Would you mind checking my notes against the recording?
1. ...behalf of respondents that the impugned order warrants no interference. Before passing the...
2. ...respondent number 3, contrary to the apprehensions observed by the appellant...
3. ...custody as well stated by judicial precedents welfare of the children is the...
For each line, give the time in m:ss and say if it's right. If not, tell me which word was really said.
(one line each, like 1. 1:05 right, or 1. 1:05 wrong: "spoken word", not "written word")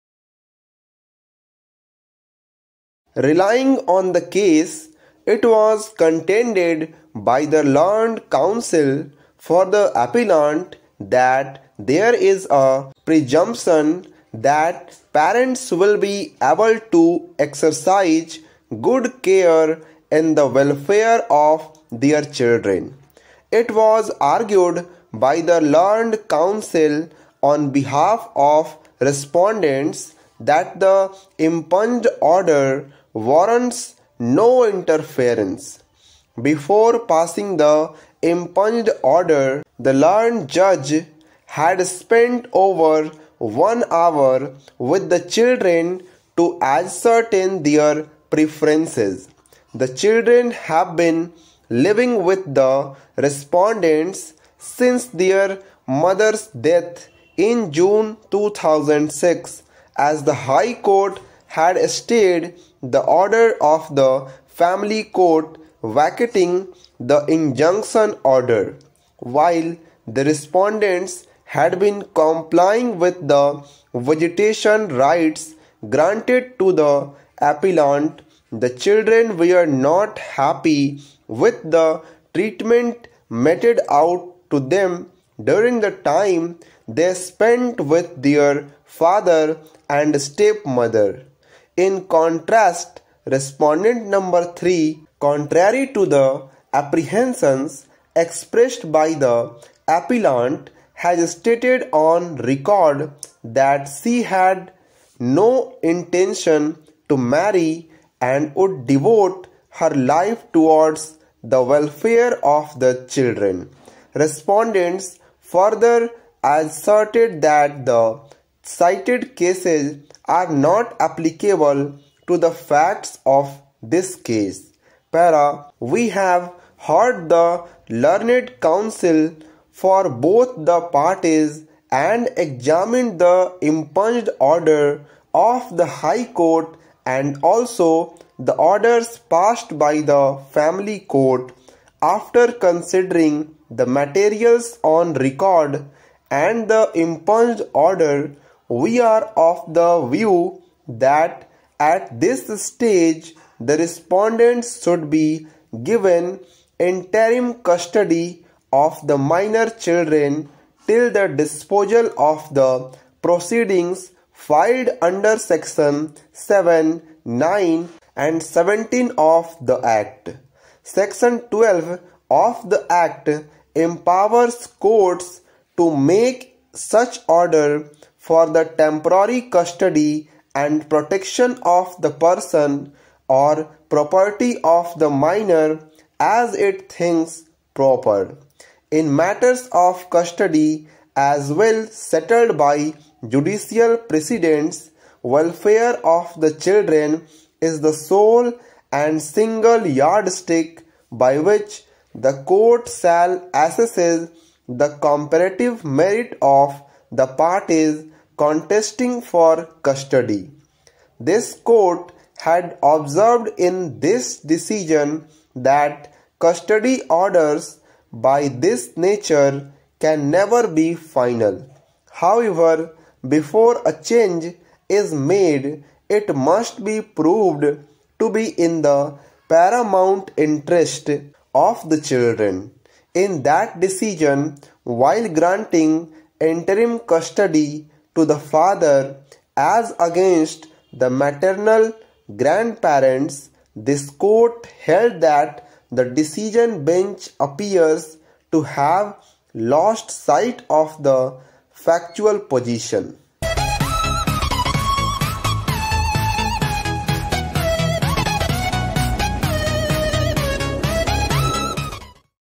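1. 0:27 right
2. 1:33 wrong: "expressed", not "observed"
3. 3:10 wrong: "settled", not "stated".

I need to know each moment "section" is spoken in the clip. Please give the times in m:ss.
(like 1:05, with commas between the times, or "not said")
2:45, 2:50.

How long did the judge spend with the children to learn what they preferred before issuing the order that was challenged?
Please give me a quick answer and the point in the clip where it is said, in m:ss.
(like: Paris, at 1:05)
over one hour, at 0:42.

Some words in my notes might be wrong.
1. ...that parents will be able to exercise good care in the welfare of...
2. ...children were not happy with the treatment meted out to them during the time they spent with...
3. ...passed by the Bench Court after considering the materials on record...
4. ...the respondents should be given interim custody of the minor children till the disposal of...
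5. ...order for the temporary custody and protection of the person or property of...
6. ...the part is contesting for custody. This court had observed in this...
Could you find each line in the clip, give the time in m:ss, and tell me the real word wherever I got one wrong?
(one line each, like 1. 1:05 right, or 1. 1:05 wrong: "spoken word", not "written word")
1. 0:14 right
2. 1:18 right
3. 2:19 wrong: "Family", not "Bench"
4. 2:33 right
5. 2:57 right
6. 3:27 right.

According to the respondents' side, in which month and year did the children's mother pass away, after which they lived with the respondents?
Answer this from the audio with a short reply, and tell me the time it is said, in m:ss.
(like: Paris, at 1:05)
June 2006, at 0:57.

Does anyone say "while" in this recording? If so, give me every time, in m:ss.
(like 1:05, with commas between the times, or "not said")
1:09, 3:54.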